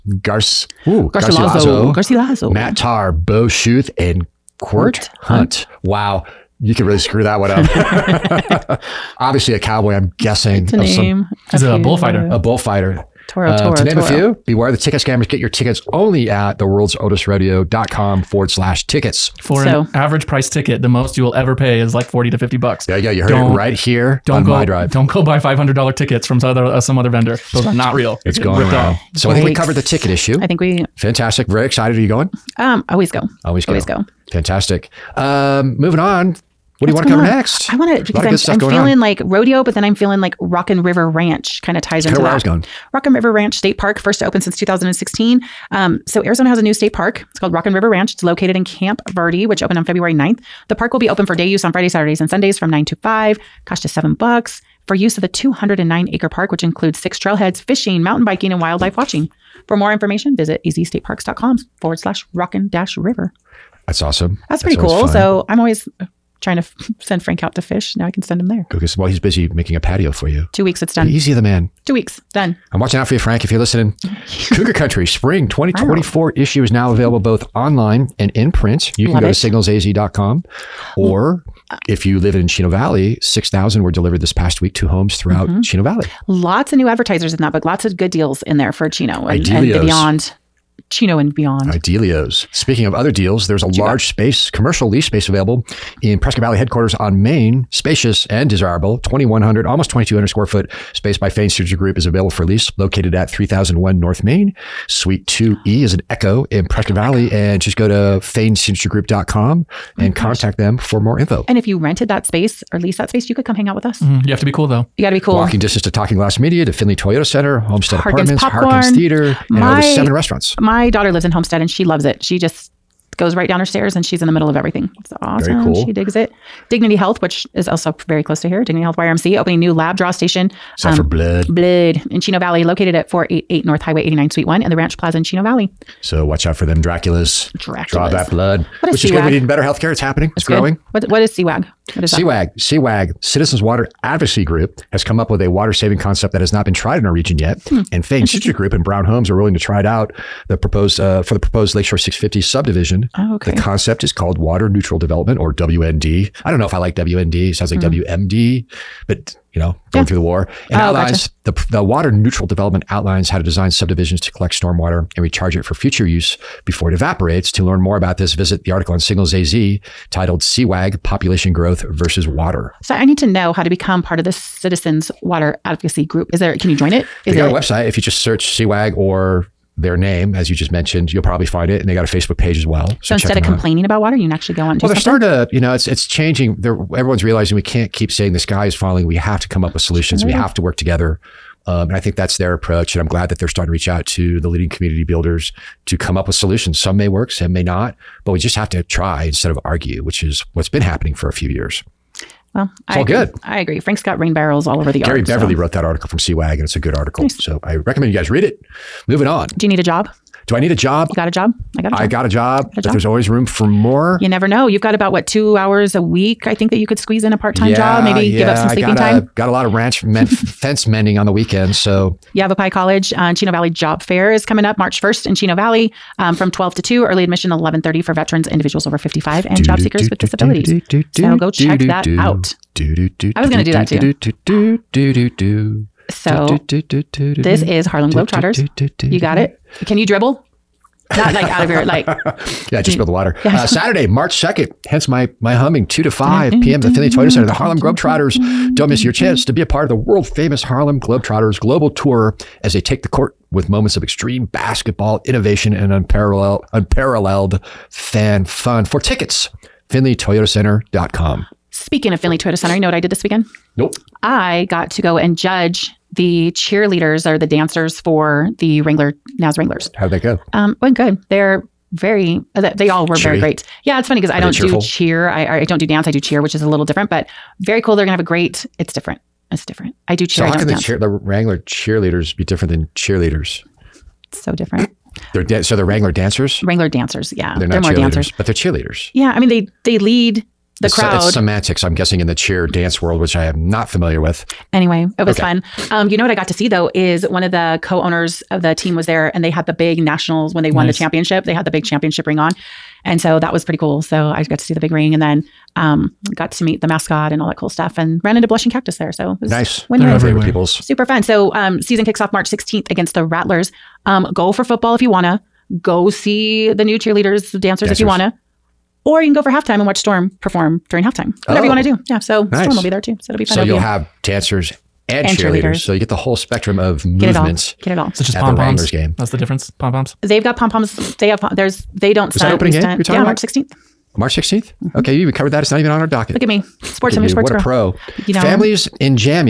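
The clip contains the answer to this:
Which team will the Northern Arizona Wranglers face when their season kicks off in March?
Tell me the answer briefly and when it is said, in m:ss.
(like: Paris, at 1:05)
the Rattlers, at 5:13.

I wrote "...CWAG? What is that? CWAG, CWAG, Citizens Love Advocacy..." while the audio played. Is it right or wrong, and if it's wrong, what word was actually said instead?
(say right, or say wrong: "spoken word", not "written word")
wrong: "Water", not "Love".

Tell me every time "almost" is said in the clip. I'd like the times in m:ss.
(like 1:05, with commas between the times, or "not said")
1:39.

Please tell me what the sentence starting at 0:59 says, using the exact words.
For more information, visit azstateparks.com forward slash rockin' dash river.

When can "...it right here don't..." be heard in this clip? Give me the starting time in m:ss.
0:23.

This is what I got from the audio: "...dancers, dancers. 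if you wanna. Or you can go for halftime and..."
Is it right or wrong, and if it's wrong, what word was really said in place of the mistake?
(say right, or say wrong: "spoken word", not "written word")
right.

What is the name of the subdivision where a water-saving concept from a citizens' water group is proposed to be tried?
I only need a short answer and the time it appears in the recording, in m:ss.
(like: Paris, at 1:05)
Lakeshore 650, at 2:31.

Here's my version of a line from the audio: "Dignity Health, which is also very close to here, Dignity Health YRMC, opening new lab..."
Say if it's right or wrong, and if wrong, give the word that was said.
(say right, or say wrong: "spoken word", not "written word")
right.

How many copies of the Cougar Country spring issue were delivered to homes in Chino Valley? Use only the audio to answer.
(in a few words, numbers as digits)
6,000.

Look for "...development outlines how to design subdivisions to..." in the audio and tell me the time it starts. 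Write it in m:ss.
2:42.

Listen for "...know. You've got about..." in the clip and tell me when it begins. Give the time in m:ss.
3:34.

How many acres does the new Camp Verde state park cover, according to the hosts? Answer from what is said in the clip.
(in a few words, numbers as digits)
209.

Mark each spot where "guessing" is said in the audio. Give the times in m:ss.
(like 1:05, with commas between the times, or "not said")
0:10, 4:51.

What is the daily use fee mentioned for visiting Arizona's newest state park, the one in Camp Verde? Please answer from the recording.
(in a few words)
$7.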